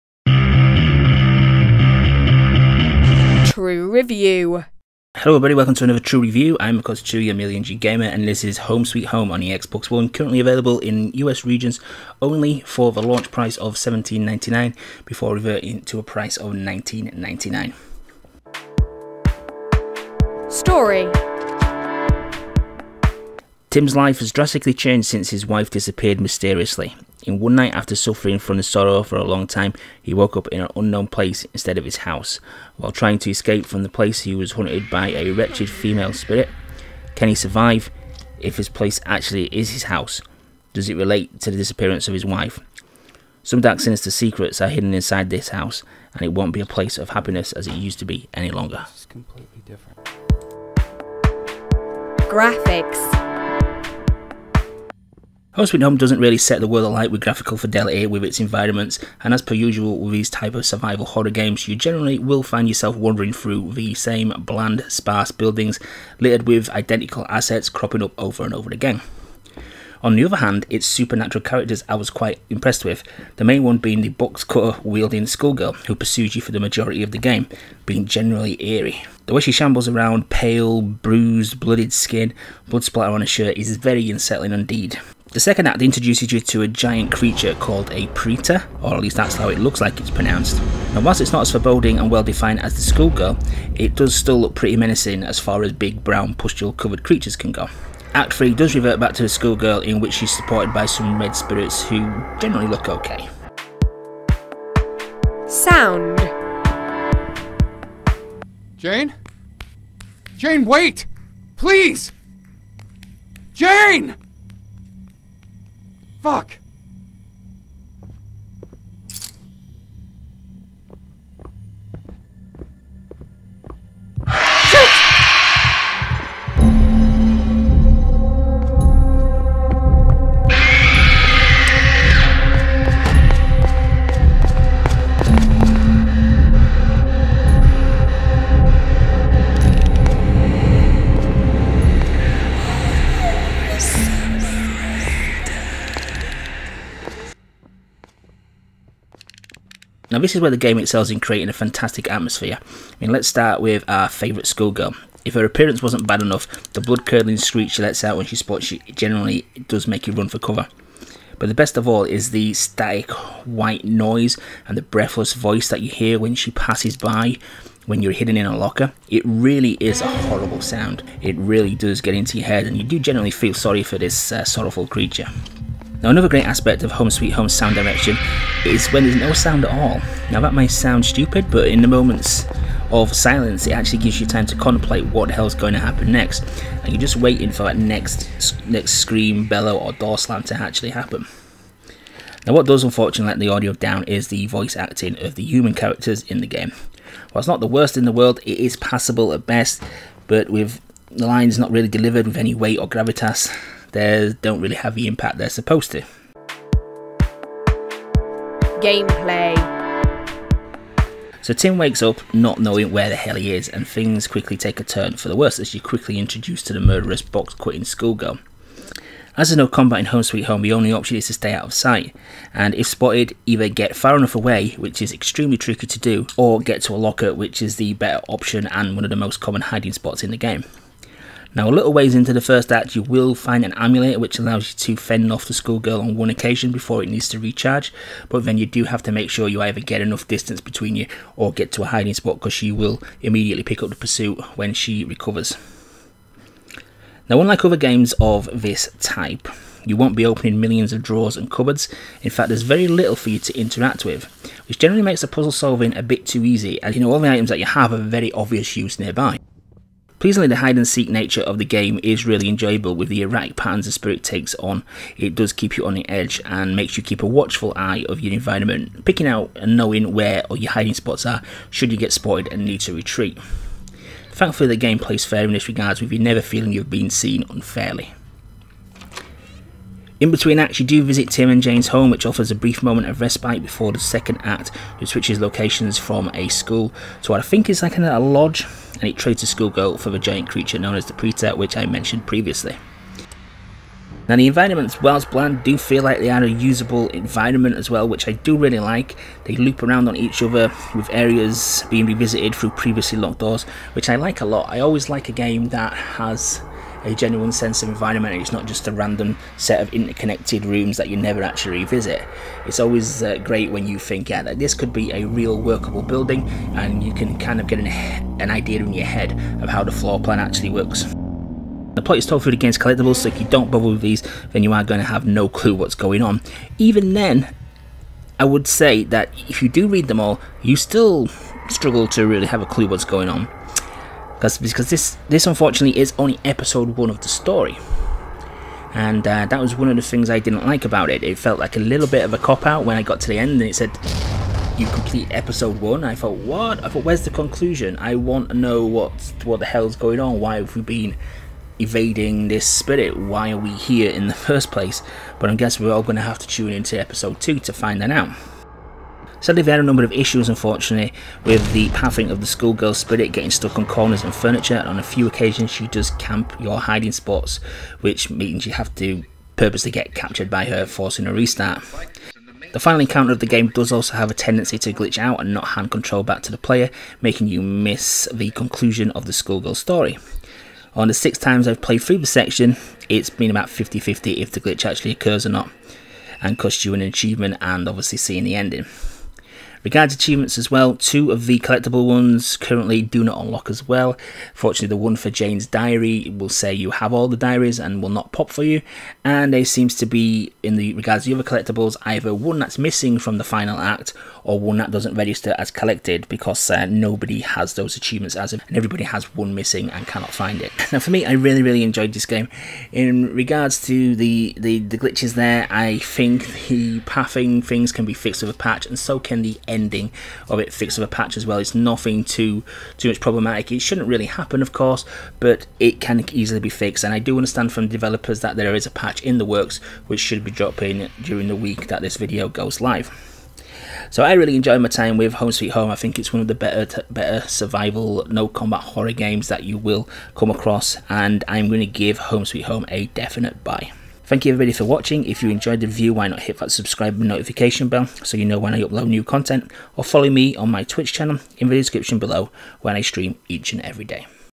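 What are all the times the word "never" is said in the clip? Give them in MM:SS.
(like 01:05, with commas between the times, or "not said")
04:36, 05:11.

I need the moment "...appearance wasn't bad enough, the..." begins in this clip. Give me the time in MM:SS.
02:35.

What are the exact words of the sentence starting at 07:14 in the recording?
So I really enjoyed my time with Home Sweet Home.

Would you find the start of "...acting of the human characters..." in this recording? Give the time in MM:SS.
03:14.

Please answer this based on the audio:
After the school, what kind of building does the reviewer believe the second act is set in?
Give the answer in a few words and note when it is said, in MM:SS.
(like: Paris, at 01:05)
lodge, at 04:48.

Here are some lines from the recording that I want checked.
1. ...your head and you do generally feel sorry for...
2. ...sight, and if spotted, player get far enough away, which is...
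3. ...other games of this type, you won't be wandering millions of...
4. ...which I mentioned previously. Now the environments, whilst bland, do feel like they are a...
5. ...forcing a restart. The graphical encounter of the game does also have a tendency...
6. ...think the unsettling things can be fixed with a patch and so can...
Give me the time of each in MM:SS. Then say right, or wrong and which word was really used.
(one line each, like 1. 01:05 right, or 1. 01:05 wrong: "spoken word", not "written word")
1. 02:52 right
2. 03:41 wrong: "either", not "player"
3. 04:07 wrong: "opening", not "wandering"
4. 04:51 right
5. 06:10 wrong: "final", not "graphical"
6. 06:55 wrong: "pathing", not "unsettling".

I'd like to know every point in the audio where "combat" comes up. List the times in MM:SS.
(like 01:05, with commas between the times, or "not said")
03:39, 07:18.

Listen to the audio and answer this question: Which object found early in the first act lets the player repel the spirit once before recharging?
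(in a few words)
amulet.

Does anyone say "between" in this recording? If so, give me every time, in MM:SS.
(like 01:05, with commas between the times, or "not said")
04:00, 04:40.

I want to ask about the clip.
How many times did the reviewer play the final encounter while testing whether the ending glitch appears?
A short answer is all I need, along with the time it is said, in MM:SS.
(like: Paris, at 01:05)
6, at 06:21.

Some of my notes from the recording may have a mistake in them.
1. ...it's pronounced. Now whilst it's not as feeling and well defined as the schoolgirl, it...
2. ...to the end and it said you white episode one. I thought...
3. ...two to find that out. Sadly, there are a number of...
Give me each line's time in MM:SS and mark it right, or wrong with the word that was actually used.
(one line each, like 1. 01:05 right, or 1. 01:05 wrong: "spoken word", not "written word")
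1. 01:29 wrong: "foreboding", not "feeling"
2. 05:43 wrong: "complete", not "white"
3. 05:57 right.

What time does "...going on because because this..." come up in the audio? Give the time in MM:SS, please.
05:33.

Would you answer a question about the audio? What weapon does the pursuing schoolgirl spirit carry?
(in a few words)
box cutter.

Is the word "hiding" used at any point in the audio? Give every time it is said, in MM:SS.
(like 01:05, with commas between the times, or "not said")
03:49, 04:01, 04:30, 06:06.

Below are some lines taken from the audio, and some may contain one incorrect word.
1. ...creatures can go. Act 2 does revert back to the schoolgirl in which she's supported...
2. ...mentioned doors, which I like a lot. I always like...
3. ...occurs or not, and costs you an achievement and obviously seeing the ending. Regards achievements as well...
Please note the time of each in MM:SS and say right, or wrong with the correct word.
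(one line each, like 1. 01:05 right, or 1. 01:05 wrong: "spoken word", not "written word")
1. 01:37 wrong: "3", not "2"
2. 05:03 wrong: "locked", not "mentioned"
3. 06:25 right.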